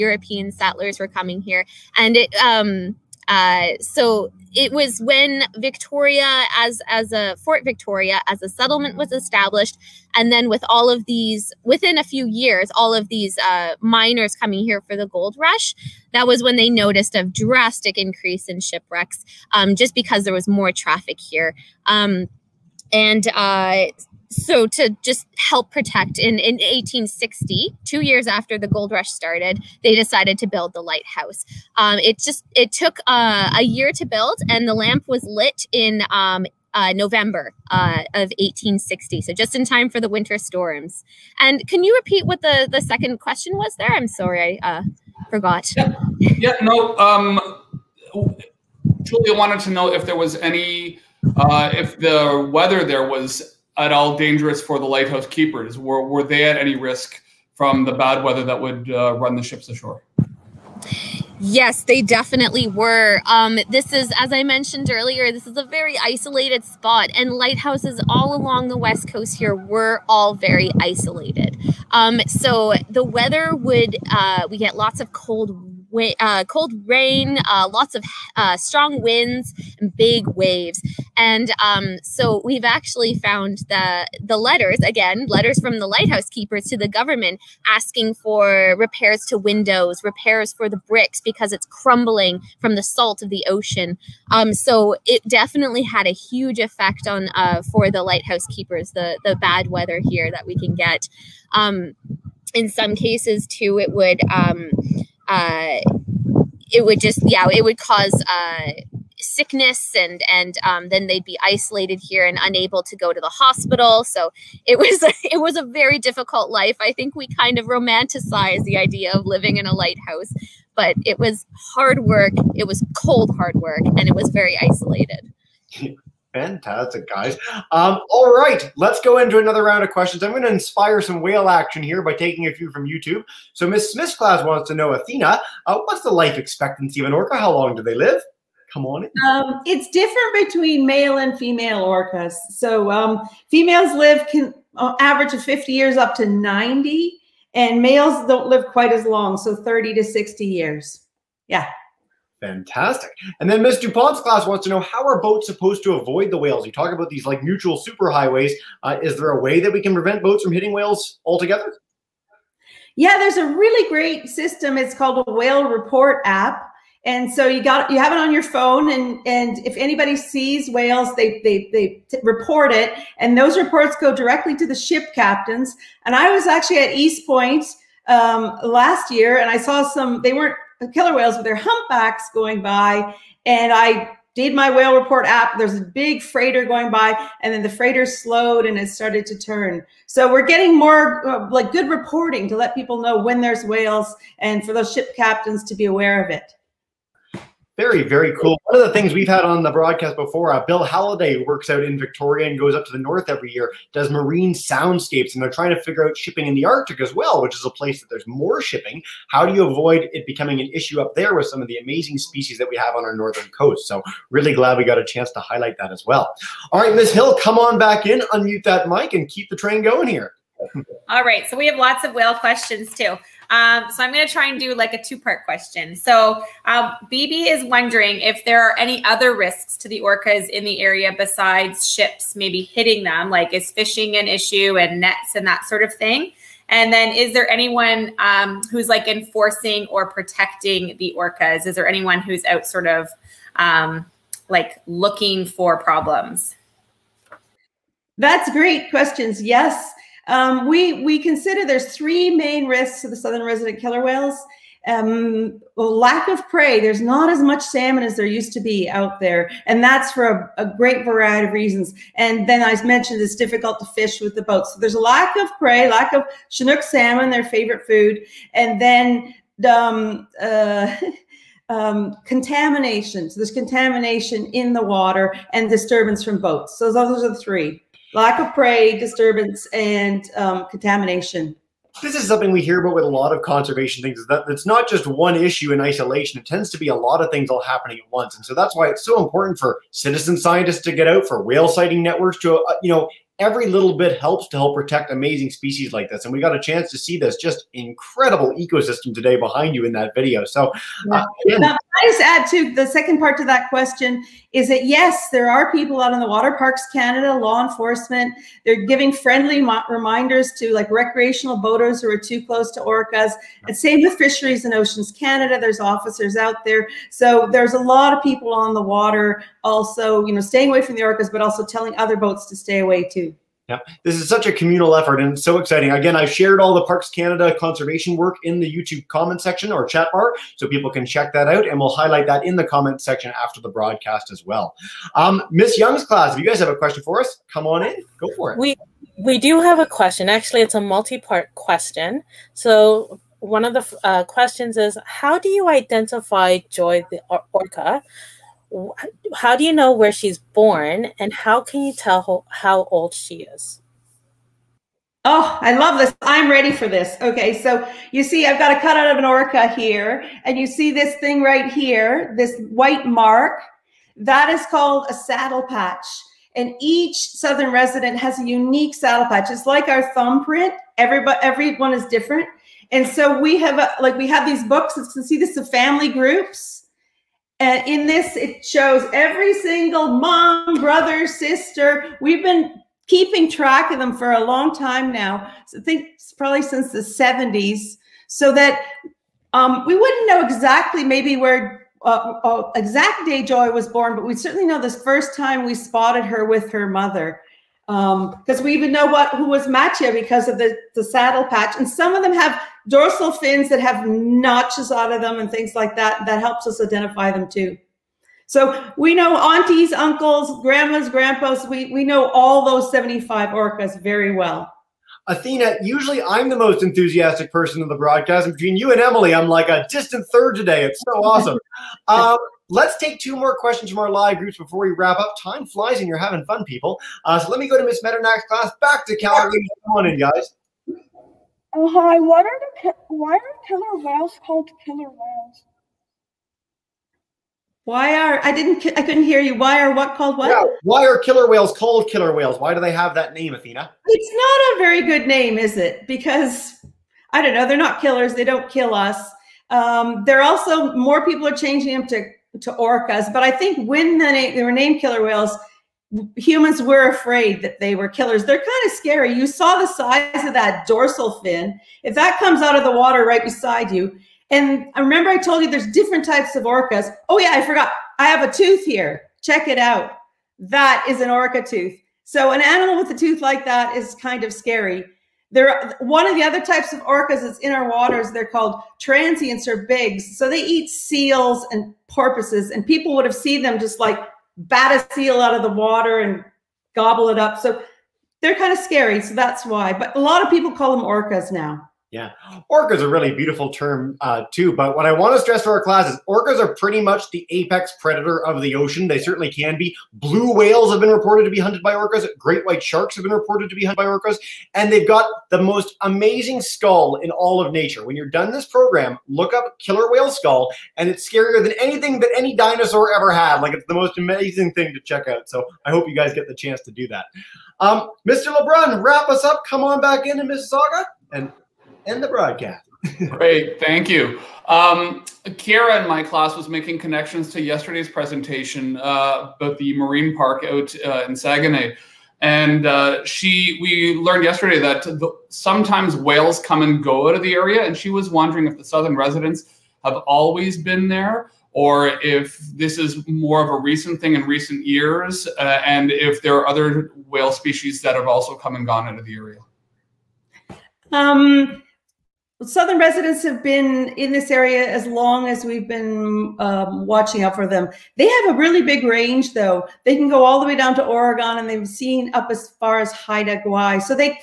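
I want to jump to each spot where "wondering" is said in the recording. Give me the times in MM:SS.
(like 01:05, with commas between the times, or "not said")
03:47, 08:58.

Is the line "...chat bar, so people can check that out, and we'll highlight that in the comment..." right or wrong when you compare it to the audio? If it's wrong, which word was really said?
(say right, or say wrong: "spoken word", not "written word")
right.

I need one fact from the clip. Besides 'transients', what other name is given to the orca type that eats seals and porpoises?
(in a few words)
Bigs.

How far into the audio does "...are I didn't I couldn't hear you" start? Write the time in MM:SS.
07:18.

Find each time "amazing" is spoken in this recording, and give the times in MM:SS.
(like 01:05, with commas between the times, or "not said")
03:31, 04:55, 08:26, 08:34.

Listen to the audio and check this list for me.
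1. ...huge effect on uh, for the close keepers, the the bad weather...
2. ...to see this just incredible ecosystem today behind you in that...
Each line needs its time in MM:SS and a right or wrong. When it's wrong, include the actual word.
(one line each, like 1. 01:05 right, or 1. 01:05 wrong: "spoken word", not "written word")
1. 01:36 wrong: "lighthouse", not "close"
2. 04:56 right.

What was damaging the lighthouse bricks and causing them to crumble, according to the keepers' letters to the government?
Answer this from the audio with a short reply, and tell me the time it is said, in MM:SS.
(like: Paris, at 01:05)
Salt of the ocean, at 01:32.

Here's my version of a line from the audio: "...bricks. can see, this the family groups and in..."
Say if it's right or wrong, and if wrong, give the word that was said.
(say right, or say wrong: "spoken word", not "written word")
wrong: "books", not "bricks".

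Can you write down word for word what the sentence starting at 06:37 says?
Because um, we even know what who was Matia because of the, the saddle patch.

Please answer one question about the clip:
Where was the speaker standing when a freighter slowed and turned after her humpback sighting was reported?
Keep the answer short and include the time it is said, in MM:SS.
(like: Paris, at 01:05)
East Point, at 02:56.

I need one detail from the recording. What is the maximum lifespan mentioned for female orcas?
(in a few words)
90 years.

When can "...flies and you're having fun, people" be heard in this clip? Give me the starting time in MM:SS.
07:05.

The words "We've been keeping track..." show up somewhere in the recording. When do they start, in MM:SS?
06:22.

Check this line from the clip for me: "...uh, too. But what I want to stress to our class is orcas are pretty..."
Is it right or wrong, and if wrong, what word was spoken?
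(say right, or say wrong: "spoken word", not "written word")
right.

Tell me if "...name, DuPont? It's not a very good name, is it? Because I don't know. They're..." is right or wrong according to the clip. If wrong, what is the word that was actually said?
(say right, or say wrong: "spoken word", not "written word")
wrong: "Athena", not "DuPont".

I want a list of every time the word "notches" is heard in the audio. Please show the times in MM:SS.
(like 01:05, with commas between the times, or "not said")
06:44.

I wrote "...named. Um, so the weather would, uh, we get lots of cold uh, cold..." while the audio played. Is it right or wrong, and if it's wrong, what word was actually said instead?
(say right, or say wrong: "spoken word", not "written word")
wrong: "isolated", not "named".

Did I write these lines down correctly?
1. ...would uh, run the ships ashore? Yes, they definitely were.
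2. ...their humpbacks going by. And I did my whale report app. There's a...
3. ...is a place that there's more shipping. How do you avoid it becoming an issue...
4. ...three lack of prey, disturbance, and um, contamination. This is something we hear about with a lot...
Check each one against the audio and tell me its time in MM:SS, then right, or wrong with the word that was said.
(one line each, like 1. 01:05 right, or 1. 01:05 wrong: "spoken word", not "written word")
1. 00:58 right
2. 03:01 right
3. 03:27 right
4. 04:37 right.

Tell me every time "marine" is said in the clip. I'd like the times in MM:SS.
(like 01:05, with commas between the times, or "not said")
03:24, 08:49.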